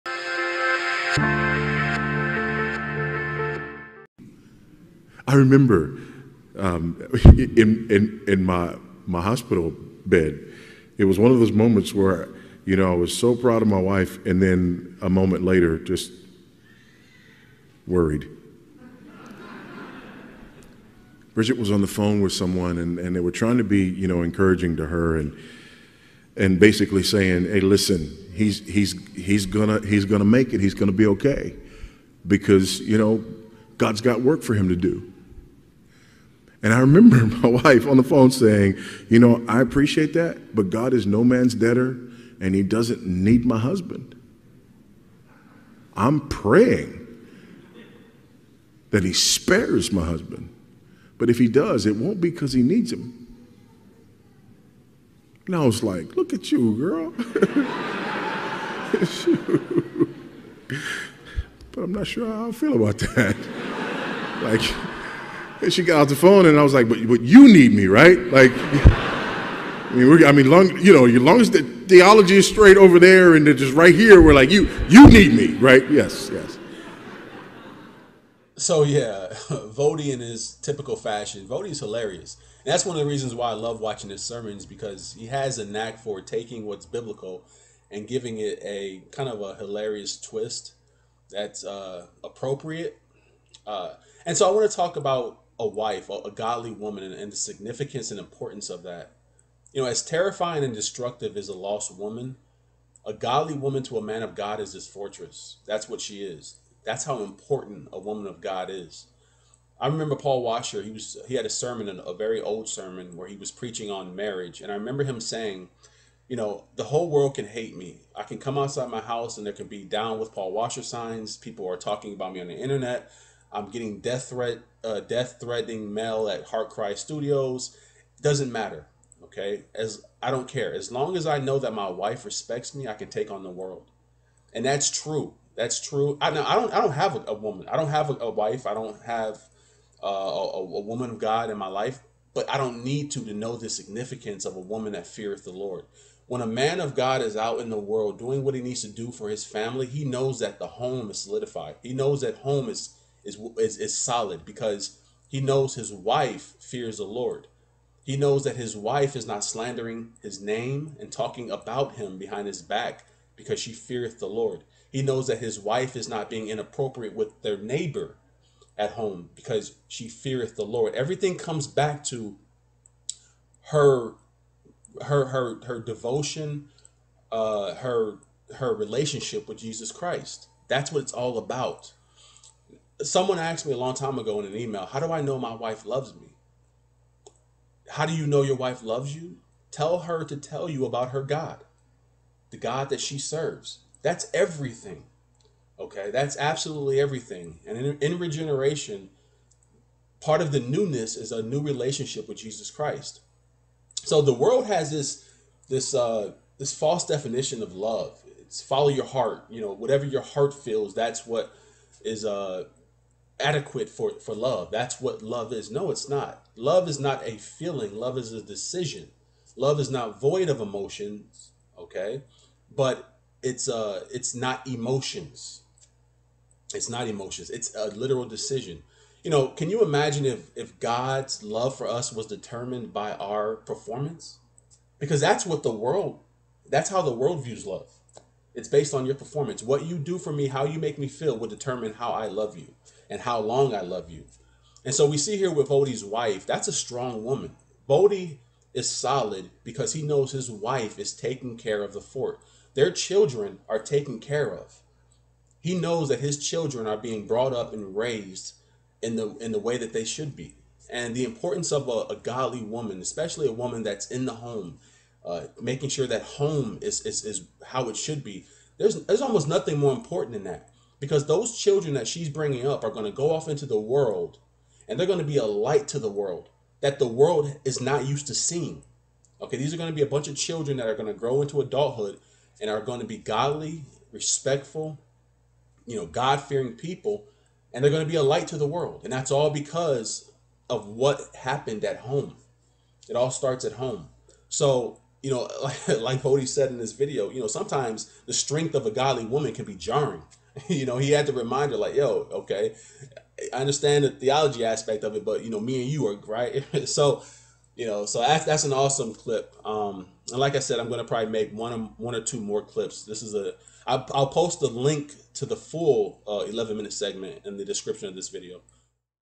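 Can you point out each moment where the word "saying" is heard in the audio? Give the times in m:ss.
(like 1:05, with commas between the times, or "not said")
0:27, 0:38, 1:55.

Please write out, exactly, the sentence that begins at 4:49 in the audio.
And that's all because of what happened at home.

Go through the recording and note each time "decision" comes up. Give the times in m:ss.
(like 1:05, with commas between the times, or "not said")
3:38, 3:48.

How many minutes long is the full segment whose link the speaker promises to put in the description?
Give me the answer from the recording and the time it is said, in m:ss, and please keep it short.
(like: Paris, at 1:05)
11, at 5:16.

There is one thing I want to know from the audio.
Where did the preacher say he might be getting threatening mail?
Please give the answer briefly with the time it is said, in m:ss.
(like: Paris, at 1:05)
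Heart Cry Studios, at 2:06.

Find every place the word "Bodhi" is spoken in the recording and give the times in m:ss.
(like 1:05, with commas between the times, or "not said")
4:07.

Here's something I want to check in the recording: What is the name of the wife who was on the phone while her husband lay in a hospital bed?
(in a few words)
Bridget.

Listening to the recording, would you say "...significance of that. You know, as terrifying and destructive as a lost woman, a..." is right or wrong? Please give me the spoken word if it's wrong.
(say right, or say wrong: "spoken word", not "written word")
wrong: "importance", not "significance".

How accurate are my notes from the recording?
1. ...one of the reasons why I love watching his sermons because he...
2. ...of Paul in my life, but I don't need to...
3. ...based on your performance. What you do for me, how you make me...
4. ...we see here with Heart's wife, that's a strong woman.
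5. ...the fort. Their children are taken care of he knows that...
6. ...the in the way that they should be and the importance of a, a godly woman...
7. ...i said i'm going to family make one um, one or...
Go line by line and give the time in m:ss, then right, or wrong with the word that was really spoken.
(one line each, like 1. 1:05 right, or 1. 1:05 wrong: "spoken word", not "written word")
1. 1:22 right
2. 2:21 wrong: "God", not "Paul"
3. 3:58 right
4. 4:05 wrong: "Voddie", not "Heart"
5. 4:11 right
6. 4:19 right
7. 5:10 wrong: "probably", not "family".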